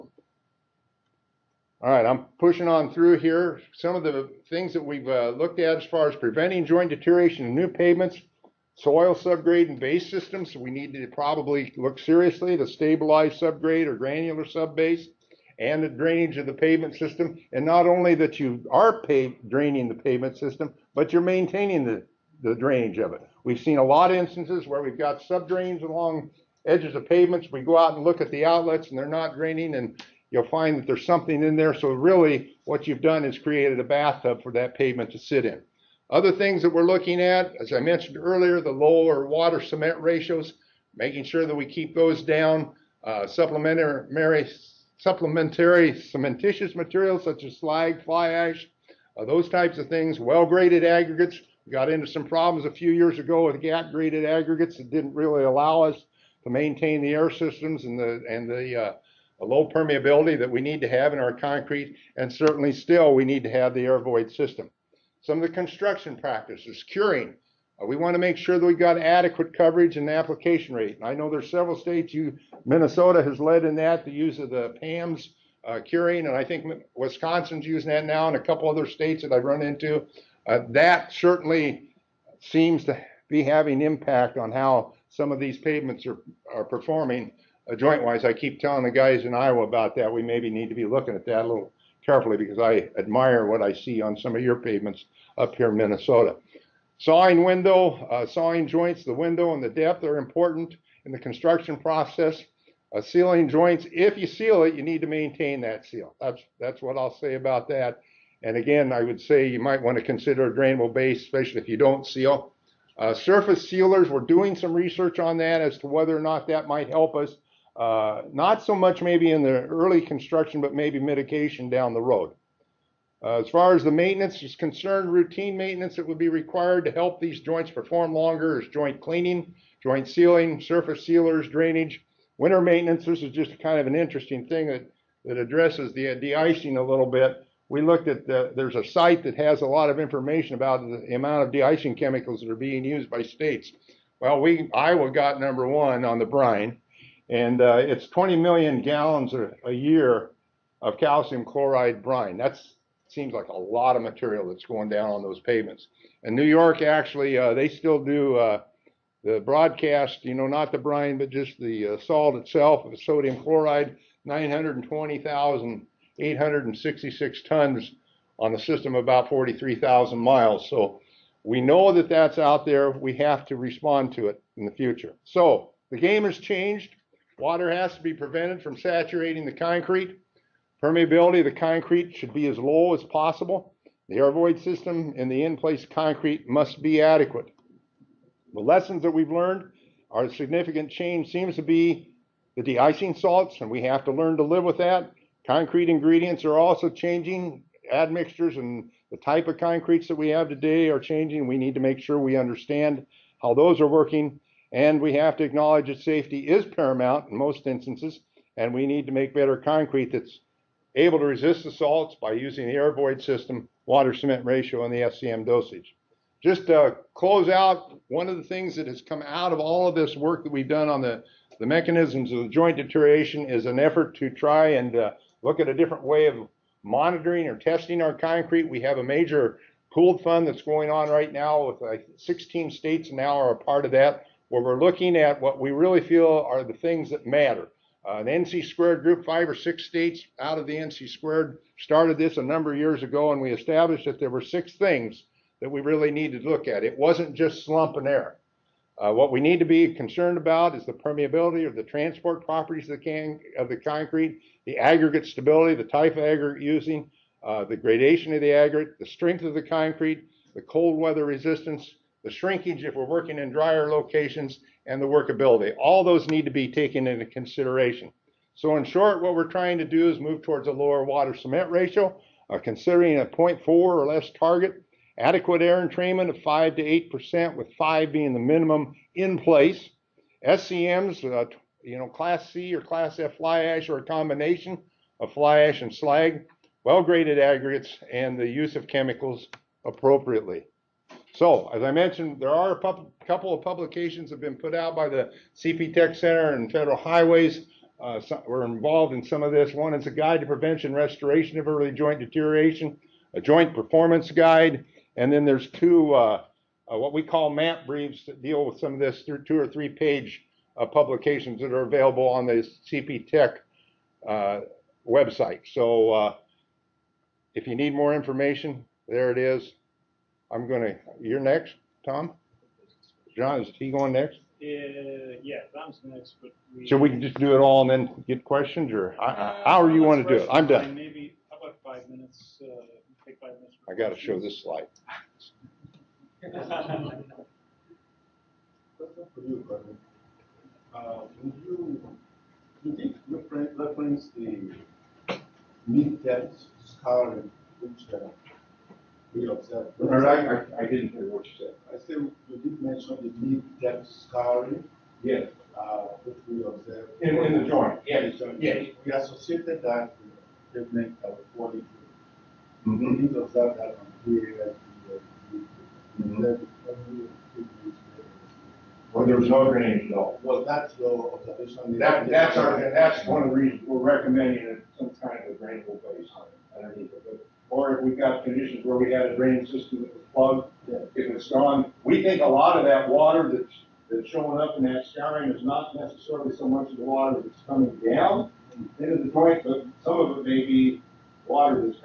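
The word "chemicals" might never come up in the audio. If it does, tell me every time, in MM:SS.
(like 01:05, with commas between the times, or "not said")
02:21, 04:48.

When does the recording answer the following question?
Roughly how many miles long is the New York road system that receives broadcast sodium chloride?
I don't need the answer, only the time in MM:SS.
02:49.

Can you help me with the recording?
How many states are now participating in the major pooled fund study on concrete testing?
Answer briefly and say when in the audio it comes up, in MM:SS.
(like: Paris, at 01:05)
16, at 03:52.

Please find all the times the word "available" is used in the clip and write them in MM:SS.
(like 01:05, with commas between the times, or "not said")
05:11.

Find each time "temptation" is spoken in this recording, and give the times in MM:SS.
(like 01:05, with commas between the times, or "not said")
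not said.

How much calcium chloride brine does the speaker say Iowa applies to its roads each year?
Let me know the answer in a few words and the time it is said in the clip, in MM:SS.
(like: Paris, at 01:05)
20 million gallons, at 02:28.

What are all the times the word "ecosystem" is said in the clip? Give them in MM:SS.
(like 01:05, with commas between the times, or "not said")
not said.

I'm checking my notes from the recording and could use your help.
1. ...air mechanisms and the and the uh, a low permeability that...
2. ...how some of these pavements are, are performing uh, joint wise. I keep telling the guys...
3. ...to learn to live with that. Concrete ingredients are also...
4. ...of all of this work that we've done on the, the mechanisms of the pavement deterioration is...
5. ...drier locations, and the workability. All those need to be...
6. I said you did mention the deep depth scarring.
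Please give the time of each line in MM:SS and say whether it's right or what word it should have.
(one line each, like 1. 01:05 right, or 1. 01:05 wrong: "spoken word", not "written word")
1. 00:57 wrong: "systems", not "mechanisms"
2. 01:24 right
3. 03:14 right
4. 03:39 wrong: "joint", not "pavement"
5. 04:23 right
6. 05:51 right.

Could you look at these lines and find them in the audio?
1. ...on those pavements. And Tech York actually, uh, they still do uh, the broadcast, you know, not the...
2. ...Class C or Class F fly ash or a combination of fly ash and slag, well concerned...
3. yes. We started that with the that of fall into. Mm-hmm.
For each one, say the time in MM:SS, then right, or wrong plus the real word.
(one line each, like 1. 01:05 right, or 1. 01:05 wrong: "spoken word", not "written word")
1. 02:35 wrong: "New", not "Tech"
2. 04:42 wrong: "graded", not "concerned"
3. 05:58 wrong: "associated", not "started".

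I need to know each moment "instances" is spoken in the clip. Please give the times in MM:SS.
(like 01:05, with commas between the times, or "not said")
00:24, 03:27.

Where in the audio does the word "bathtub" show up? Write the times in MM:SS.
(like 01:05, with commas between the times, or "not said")
00:33.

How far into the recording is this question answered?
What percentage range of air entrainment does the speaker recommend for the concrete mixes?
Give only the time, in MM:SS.
04:36.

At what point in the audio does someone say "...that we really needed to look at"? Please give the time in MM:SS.
04:05.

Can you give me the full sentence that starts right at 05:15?
So, uh, if you need more information, there it is.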